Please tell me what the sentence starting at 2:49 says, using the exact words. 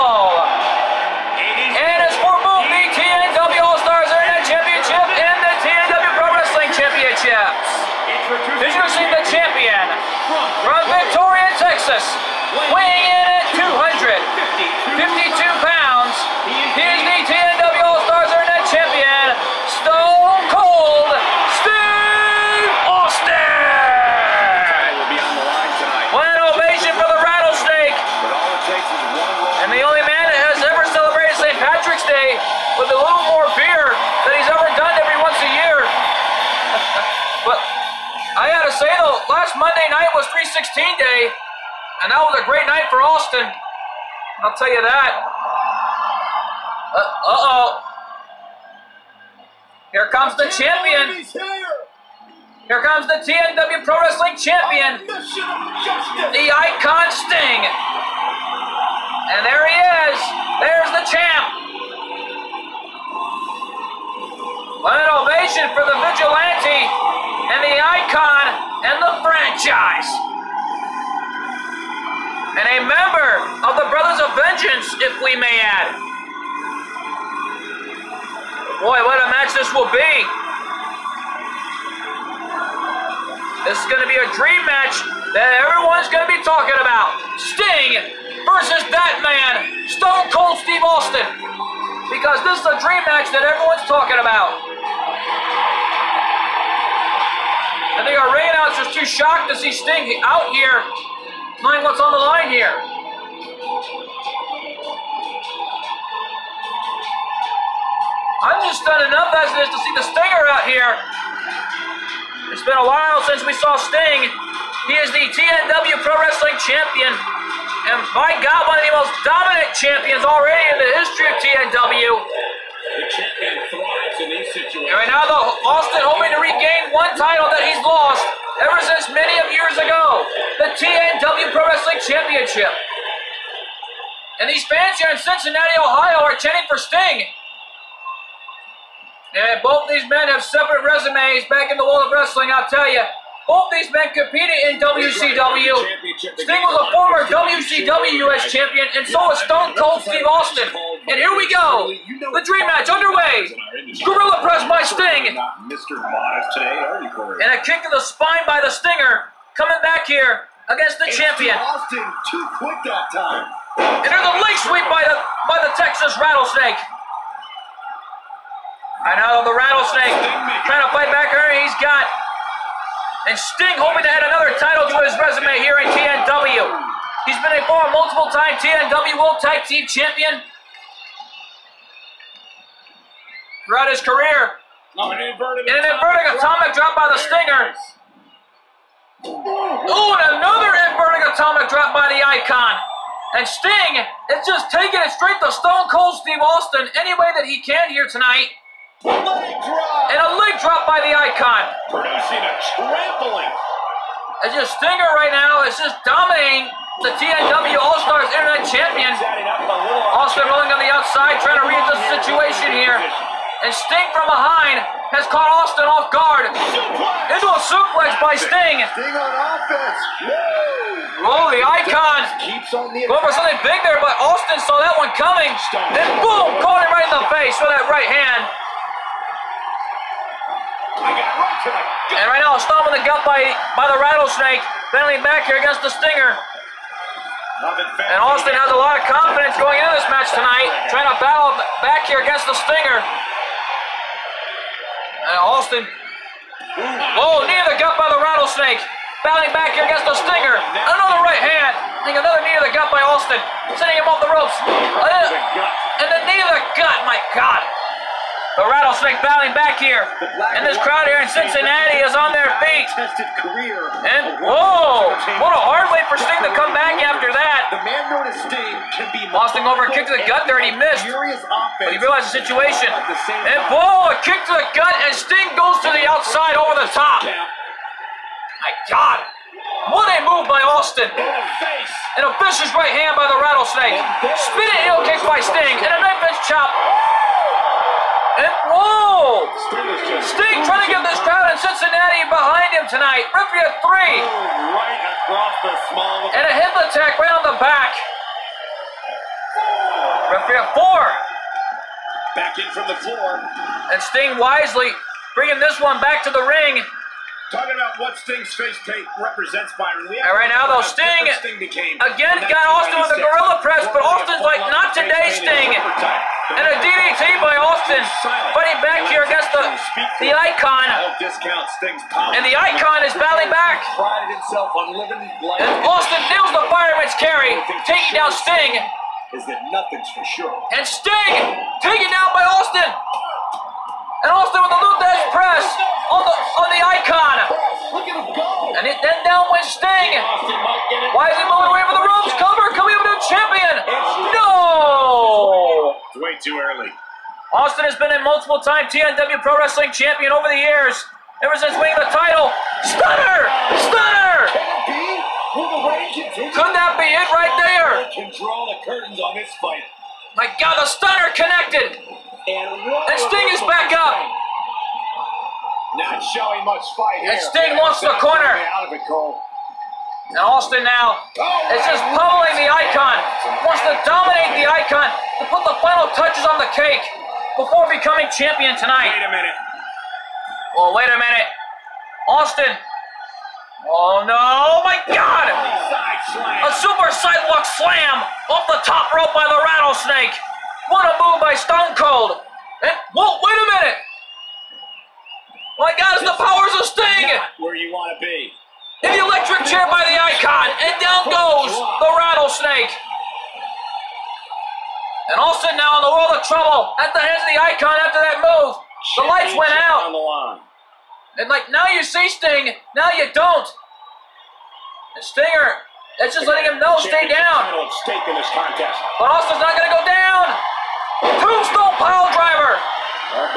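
I know the rattlesnake trying to fight back here.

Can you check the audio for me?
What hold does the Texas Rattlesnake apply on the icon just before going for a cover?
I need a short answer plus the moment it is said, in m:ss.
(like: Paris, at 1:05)
Lou Thesz press, at 5:34.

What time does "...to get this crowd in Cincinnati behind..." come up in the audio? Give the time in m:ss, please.
4:50.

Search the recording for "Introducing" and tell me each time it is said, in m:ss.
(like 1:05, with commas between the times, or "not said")
0:08.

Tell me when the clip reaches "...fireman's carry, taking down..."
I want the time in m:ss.
5:26.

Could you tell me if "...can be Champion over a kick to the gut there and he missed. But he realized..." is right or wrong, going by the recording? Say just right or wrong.
wrong.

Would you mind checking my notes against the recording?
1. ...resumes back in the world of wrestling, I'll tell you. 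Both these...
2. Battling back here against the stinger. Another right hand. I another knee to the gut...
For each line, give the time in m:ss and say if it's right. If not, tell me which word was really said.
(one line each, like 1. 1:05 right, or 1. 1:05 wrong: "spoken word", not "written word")
1. 2:20 right
2. 4:09 right.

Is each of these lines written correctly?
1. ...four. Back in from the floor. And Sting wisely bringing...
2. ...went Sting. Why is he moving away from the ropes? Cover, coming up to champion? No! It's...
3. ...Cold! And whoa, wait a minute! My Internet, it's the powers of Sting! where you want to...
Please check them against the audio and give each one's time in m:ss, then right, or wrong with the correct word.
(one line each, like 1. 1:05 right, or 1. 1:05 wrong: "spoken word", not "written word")
1. 5:00 right
2. 5:39 right
3. 6:31 wrong: "God", not "Internet".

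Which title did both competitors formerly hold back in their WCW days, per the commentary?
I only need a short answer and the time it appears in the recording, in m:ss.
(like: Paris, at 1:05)
WCW U.S. champion, at 2:27.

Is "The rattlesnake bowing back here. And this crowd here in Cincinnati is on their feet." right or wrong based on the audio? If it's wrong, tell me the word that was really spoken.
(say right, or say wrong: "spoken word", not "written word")
right.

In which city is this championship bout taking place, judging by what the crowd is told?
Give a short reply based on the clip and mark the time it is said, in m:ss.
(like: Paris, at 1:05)
Cincinnati, Ohio, at 2:15.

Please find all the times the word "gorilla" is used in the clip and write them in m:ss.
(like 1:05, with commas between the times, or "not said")
2:34, 5:13.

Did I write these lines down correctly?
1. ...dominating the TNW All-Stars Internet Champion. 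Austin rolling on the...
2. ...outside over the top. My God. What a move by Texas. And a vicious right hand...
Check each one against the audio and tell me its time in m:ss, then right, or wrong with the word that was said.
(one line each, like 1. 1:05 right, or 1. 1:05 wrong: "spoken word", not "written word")
1. 3:26 right
2. 4:36 wrong: "Austin", not "Texas".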